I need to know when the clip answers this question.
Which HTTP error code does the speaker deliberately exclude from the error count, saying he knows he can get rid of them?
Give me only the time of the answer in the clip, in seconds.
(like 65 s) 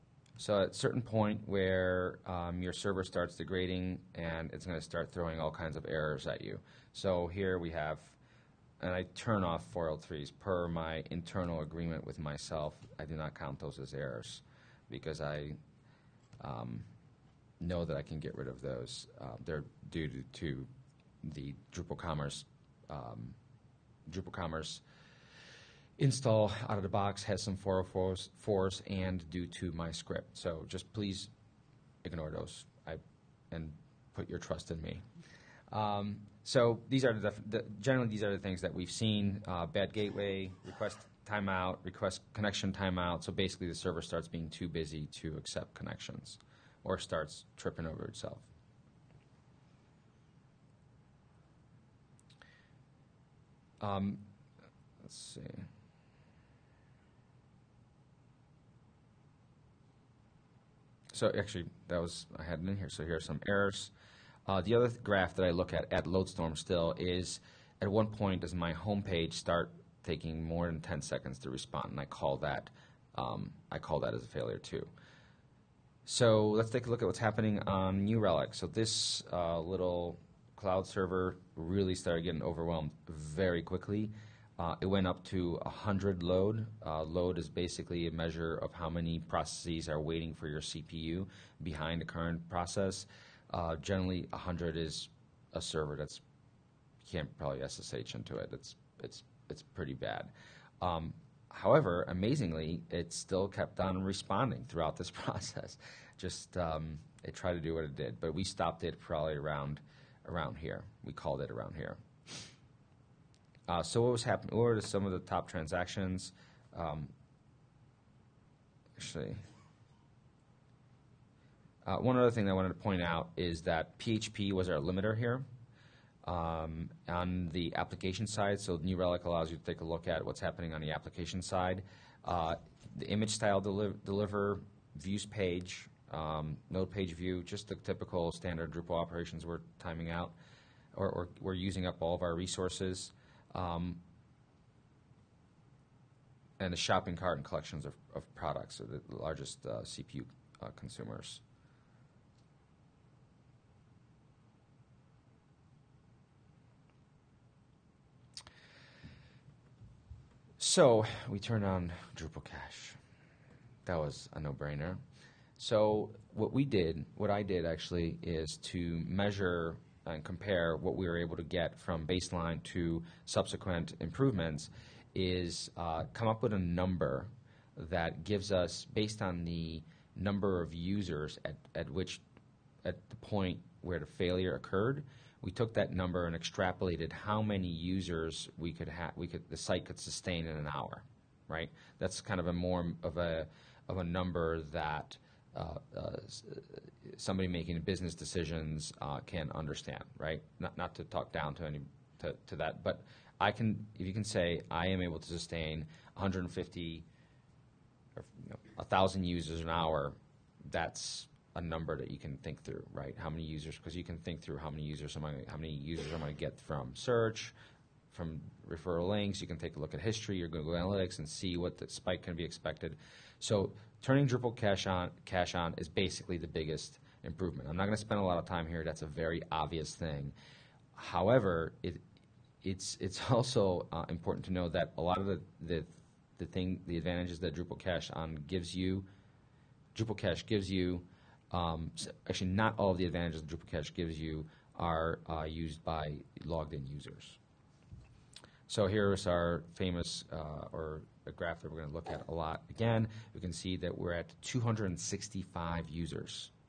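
9 s.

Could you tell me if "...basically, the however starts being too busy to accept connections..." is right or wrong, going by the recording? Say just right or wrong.
wrong.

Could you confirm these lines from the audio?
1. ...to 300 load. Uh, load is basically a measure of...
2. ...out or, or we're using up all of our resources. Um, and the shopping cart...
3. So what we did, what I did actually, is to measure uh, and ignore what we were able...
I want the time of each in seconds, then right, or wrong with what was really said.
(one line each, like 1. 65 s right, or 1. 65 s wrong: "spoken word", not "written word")
1. 85 s wrong: "100", not "300"
2. 140 s right
3. 165 s wrong: "compare", not "ignore".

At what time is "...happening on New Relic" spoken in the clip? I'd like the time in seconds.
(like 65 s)
77 s.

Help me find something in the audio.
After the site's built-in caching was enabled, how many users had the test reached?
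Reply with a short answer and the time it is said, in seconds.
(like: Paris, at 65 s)
265, at 254 s.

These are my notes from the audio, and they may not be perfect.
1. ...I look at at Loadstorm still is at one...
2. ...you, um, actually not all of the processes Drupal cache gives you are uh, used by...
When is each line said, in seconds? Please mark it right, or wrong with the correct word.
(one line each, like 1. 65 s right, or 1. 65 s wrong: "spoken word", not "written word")
1. 65 s right
2. 240 s wrong: "advantages", not "processes".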